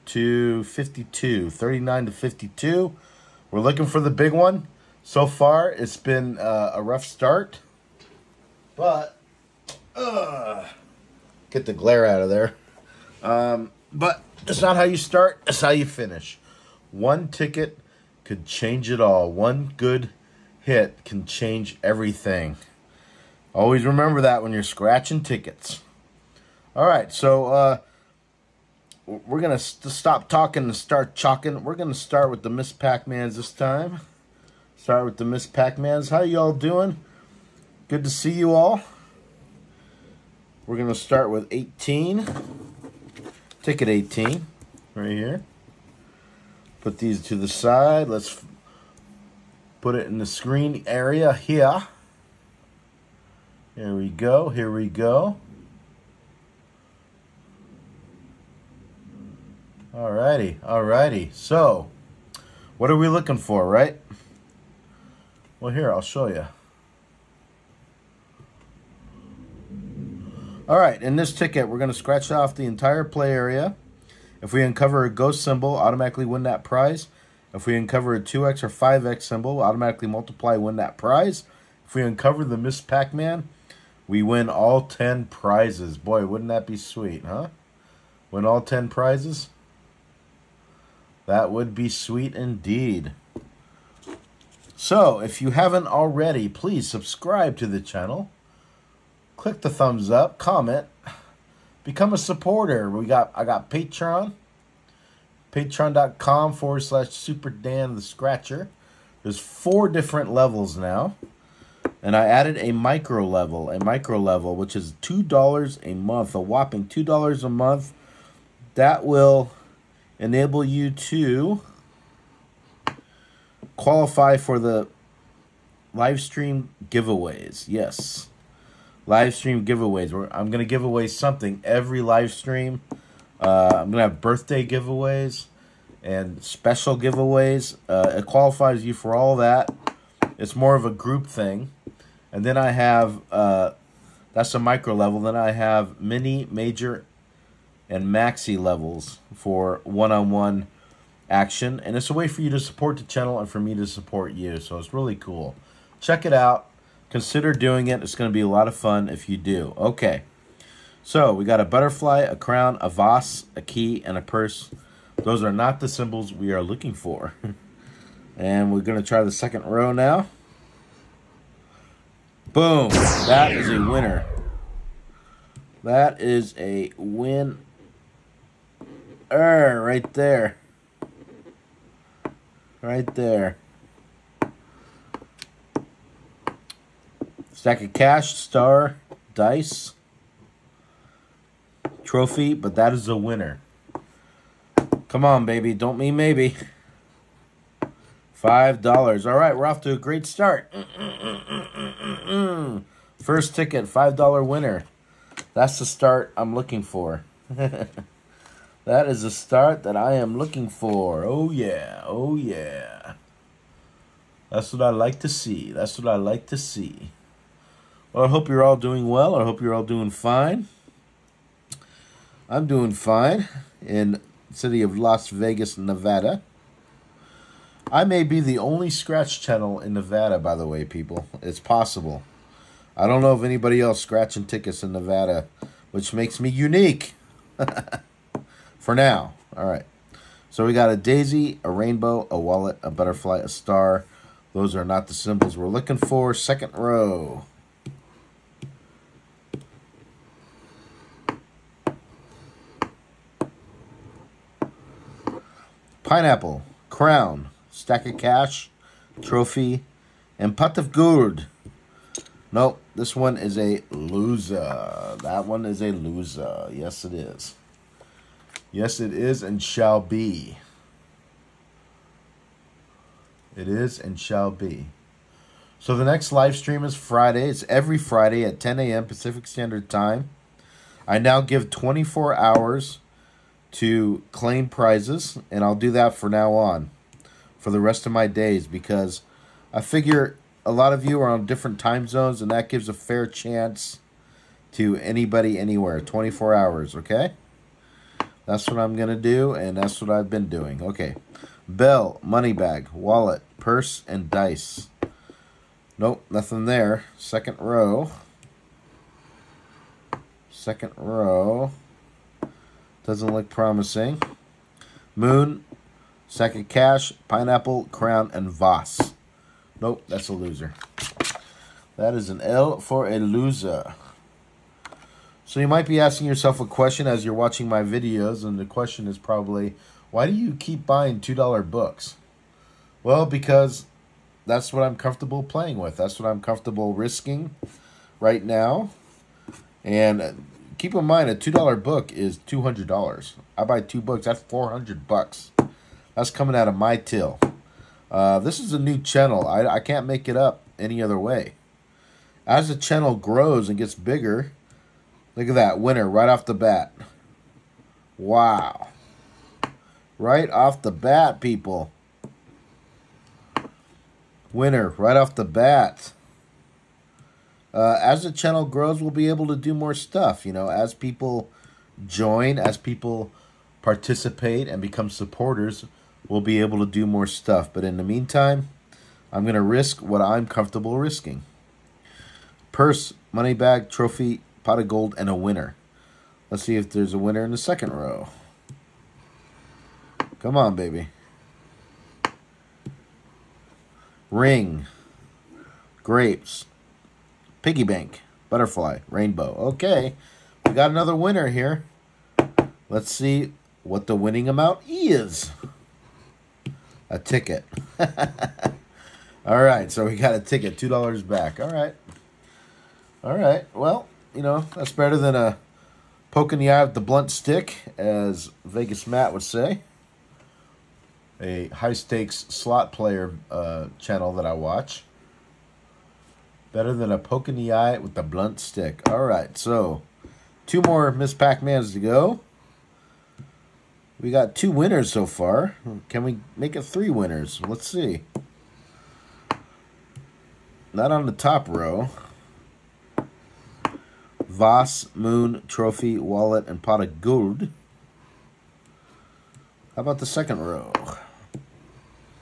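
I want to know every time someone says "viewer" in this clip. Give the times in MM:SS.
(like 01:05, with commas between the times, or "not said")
not said.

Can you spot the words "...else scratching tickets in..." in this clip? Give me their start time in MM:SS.
03:53.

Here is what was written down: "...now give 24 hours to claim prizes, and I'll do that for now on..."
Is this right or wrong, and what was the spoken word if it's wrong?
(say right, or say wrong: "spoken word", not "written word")
right.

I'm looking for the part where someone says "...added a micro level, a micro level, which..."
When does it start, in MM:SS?
01:52.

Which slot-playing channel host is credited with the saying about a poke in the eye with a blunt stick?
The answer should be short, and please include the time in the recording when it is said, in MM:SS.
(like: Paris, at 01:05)
Vegas Matt, at 06:58.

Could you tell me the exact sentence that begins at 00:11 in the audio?
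Get the glare out of there.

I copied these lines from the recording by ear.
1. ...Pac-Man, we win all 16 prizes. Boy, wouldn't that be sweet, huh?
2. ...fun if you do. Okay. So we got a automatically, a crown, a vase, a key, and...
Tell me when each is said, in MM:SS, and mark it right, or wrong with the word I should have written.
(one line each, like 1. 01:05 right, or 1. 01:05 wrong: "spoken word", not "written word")
1. 01:22 wrong: "10", not "16"
2. 02:38 wrong: "butterfly", not "automatically".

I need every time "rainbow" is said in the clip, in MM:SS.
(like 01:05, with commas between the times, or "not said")
04:01, 06:39.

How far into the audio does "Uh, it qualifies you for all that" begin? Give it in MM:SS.
02:17.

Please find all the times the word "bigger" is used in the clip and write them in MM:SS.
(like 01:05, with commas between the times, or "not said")
05:53.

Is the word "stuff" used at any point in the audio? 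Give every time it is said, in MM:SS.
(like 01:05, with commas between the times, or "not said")
06:09, 06:17.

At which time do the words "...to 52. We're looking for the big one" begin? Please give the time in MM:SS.
00:02.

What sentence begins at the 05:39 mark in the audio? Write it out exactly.
And keep in mind a two dollar book is two hundred dollars.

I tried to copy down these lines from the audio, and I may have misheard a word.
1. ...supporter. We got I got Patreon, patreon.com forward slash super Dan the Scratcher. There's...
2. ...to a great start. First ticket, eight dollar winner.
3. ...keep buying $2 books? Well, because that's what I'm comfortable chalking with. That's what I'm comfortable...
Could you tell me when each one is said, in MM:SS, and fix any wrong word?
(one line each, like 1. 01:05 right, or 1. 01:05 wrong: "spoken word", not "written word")
1. 01:42 right
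2. 03:19 wrong: "five", not "eight"
3. 05:30 wrong: "playing", not "chalking".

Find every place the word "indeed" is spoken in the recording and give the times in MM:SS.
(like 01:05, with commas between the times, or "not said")
01:32.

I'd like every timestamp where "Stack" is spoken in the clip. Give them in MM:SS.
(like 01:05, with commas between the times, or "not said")
03:07, 04:17.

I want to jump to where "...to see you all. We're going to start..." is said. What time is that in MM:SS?
00:38.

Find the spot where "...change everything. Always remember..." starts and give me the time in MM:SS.
00:21.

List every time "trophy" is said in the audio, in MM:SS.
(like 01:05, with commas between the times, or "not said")
03:12, 04:19, 06:23, 07:25.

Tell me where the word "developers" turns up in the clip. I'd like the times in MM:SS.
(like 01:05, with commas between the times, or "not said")
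not said.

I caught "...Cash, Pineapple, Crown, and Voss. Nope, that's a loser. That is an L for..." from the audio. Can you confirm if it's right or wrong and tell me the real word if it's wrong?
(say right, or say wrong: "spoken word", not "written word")
right.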